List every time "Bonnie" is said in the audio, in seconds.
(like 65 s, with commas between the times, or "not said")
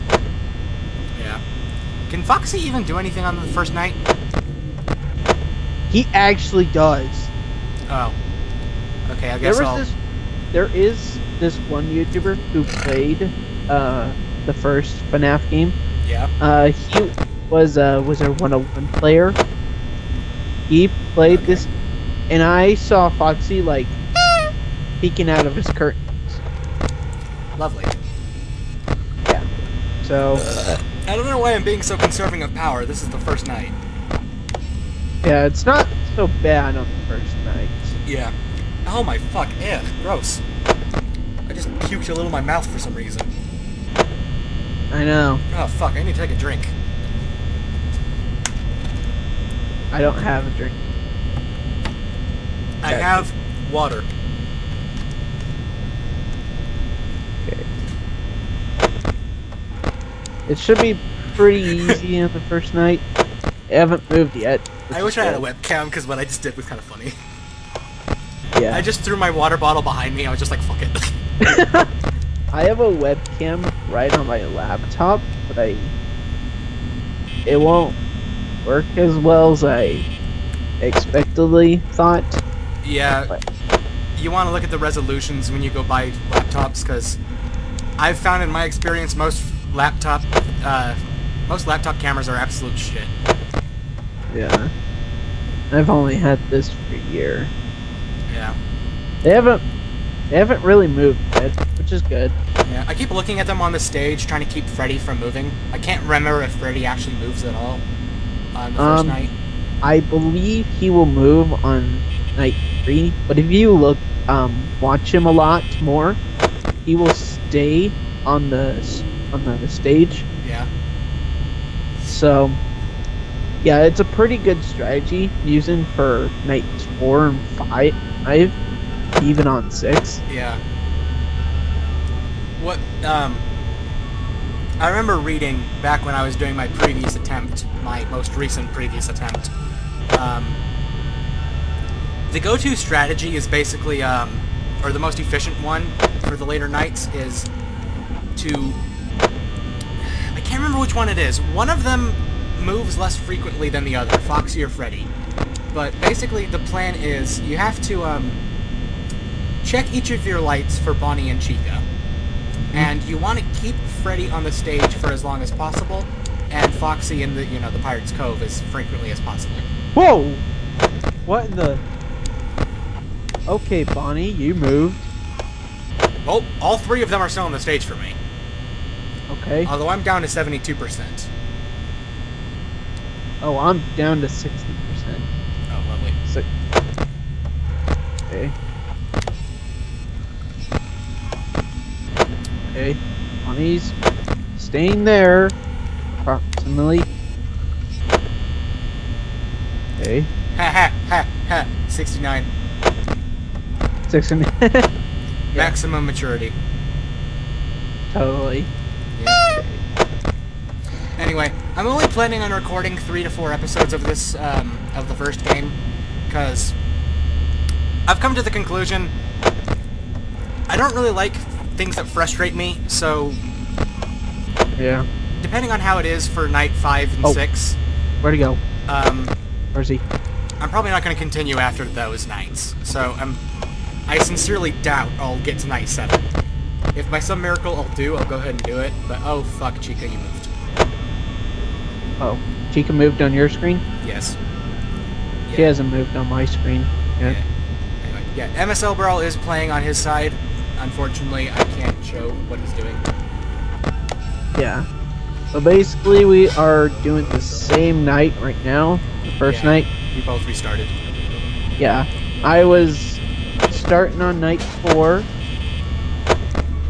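160 s, 173 s.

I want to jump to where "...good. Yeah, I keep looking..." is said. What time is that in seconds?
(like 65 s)
102 s.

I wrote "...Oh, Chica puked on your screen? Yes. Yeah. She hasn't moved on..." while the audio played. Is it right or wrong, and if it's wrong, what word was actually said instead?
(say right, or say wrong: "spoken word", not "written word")
wrong: "moved", not "puked".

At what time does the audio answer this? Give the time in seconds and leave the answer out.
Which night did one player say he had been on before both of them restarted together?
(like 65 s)
264 s.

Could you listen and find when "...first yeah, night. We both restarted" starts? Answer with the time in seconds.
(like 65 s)
259 s.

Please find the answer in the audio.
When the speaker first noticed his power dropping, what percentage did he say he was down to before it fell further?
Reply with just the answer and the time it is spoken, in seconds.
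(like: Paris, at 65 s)
72%, at 180 s.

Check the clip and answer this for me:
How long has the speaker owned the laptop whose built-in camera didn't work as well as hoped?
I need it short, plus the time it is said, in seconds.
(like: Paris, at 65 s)
a year, at 96 s.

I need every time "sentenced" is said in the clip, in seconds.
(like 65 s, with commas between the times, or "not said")
not said.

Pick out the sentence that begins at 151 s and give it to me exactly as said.
One of them moves less frequently than the other, Foxy or Freddy.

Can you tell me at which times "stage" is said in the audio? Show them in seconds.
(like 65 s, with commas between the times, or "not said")
103 s, 119 s, 164 s, 177 s.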